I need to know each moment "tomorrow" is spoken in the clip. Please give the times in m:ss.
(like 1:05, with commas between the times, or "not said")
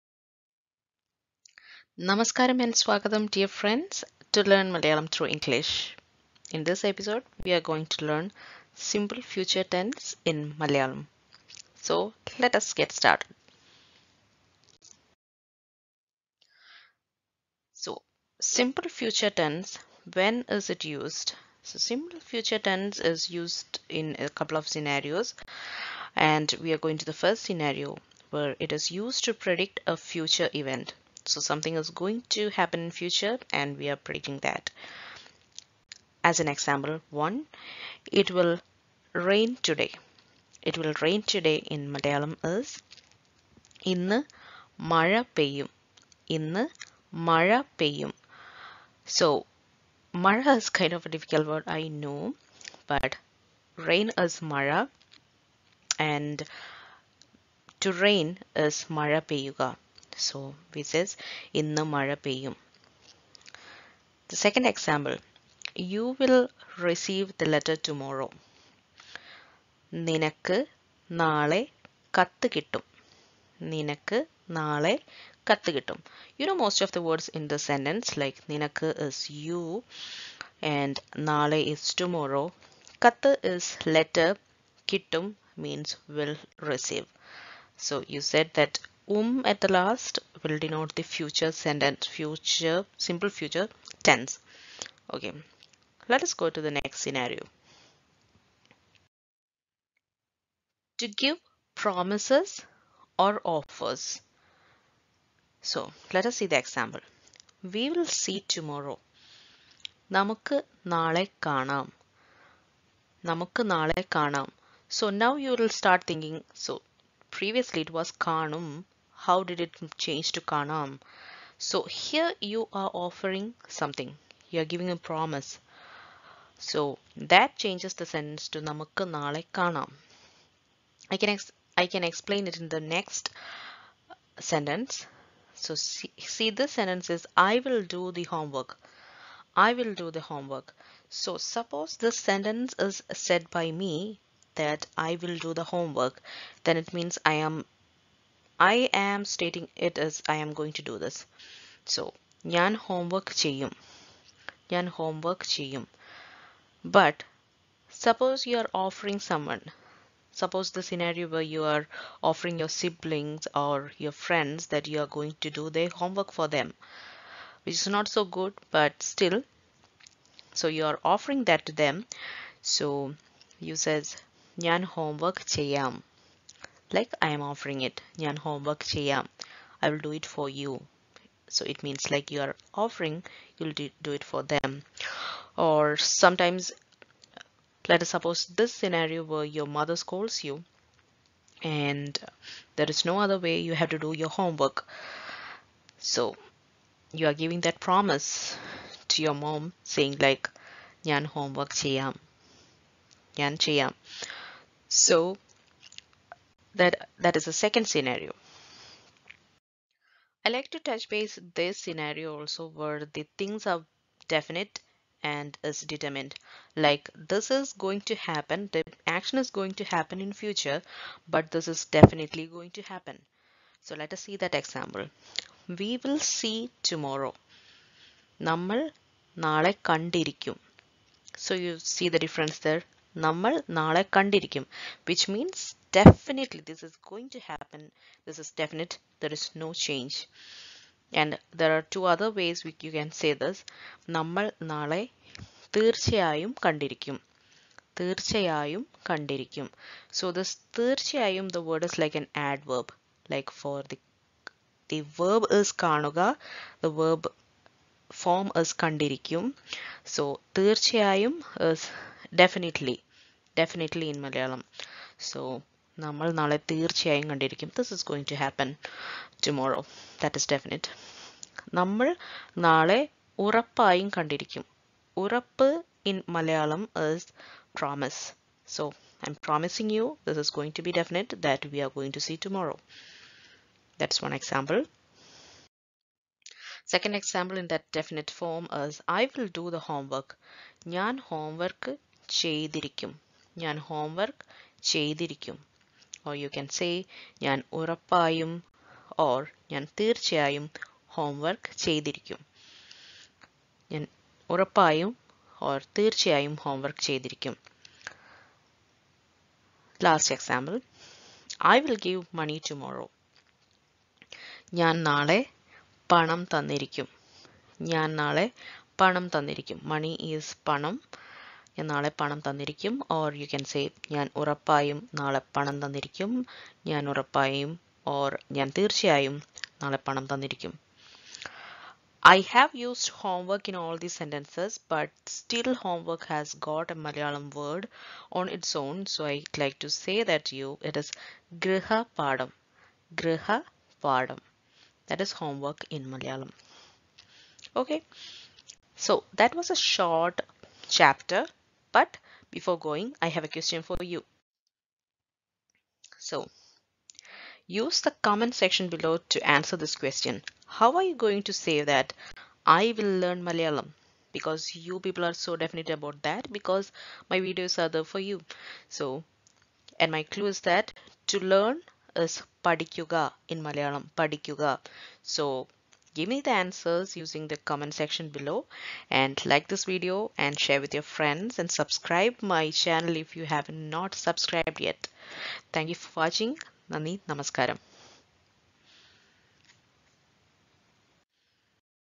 1:07, 1:21, 1:48, 3:46.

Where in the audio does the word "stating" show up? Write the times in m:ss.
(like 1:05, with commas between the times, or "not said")
2:29.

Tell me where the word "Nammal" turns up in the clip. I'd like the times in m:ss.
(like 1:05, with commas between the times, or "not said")
3:48, 3:53, 4:04.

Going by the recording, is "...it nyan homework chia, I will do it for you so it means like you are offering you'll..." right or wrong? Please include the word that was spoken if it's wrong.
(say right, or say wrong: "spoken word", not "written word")
right.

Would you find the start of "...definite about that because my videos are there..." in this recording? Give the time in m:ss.
6:05.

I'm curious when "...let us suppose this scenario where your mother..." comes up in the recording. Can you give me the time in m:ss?
3:07.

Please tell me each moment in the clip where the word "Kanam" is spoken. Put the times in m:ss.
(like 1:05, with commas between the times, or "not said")
2:00, 2:09.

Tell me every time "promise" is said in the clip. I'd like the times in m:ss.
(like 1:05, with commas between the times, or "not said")
1:41, 2:04, 3:17.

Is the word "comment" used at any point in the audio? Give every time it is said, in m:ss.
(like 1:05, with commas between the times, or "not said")
5:58, 6:17.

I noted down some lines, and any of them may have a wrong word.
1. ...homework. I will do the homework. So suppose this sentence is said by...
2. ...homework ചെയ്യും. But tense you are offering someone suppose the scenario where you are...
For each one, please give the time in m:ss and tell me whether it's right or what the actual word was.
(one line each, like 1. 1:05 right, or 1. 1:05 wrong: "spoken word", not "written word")
1. 2:18 right
2. 2:34 wrong: "suppose", not "tense".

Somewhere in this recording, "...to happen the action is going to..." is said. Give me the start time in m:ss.
3:38.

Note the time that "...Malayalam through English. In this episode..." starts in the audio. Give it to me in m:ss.
0:04.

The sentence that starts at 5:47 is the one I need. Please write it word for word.
Okay, so that was a short chapter but before going, I have a question for you.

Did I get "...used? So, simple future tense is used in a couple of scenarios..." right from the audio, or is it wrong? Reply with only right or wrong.
right.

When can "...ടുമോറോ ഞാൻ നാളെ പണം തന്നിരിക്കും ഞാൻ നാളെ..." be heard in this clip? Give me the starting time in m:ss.
5:12.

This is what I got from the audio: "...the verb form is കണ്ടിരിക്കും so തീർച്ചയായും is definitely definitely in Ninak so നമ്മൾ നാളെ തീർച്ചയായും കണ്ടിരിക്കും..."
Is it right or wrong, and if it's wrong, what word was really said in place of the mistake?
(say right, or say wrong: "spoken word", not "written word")
wrong: "Malayalam", not "Ninak".